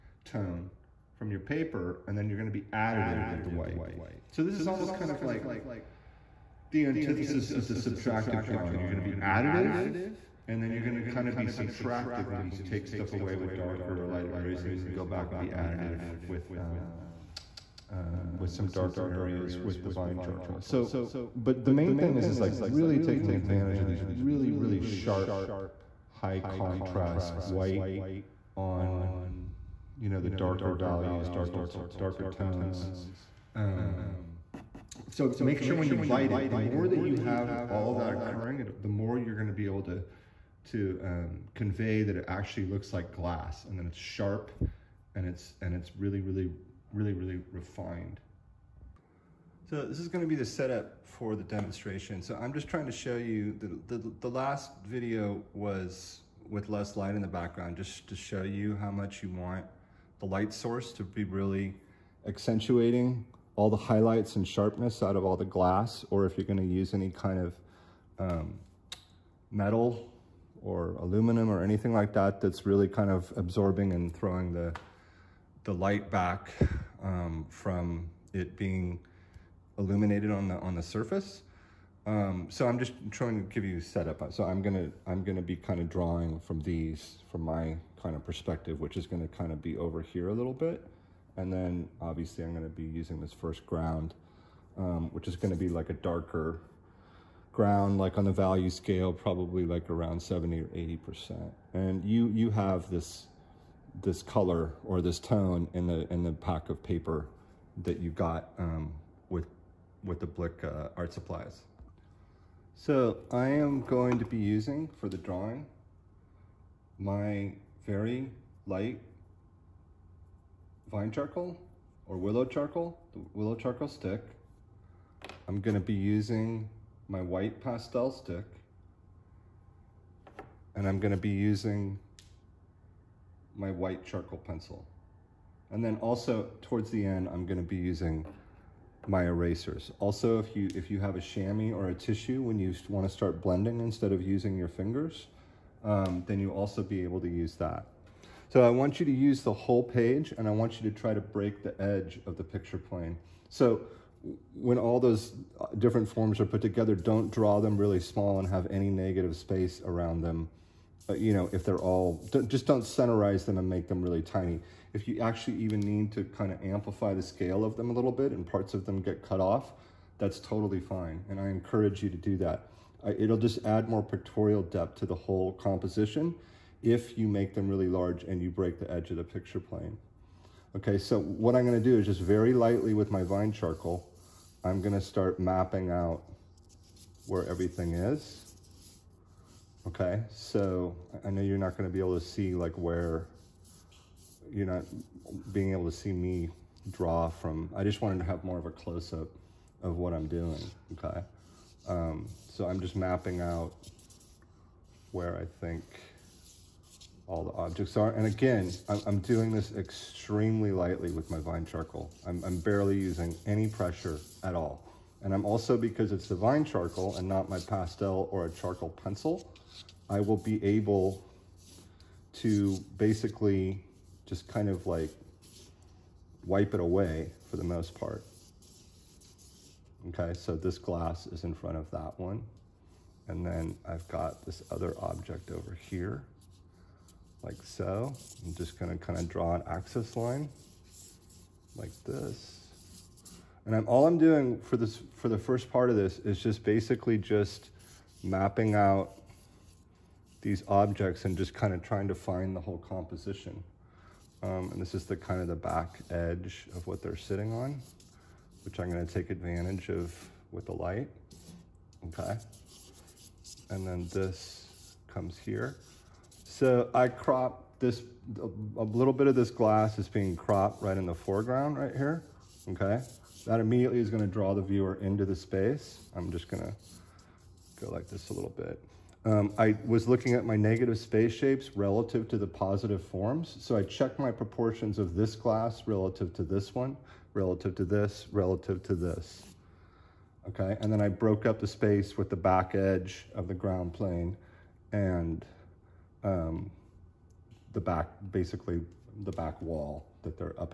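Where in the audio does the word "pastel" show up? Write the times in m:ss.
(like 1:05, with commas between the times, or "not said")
2:07, 3:37.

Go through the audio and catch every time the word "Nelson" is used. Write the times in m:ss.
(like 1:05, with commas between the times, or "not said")
not said.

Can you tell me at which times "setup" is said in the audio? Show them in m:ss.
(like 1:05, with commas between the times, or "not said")
0:50, 1:23.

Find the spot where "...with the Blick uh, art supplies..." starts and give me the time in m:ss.
1:50.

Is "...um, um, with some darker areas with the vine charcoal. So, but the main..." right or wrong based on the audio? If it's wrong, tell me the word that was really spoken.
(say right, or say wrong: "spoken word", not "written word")
right.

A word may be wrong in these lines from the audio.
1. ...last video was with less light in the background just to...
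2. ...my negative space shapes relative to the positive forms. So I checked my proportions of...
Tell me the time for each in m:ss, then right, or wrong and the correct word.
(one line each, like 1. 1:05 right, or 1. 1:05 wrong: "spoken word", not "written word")
1. 0:54 right
2. 4:40 right.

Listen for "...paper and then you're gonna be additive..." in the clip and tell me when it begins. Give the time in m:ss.
0:01.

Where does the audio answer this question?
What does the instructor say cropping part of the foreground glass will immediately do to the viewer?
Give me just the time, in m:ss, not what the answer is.
4:34.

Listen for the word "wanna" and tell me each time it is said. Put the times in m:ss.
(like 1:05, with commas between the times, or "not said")
2:22.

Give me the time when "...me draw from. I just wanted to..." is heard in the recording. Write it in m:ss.
3:16.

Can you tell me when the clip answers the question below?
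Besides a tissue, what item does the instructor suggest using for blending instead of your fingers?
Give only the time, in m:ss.
2:21.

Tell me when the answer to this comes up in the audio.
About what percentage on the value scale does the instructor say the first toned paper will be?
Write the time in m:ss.
1:40.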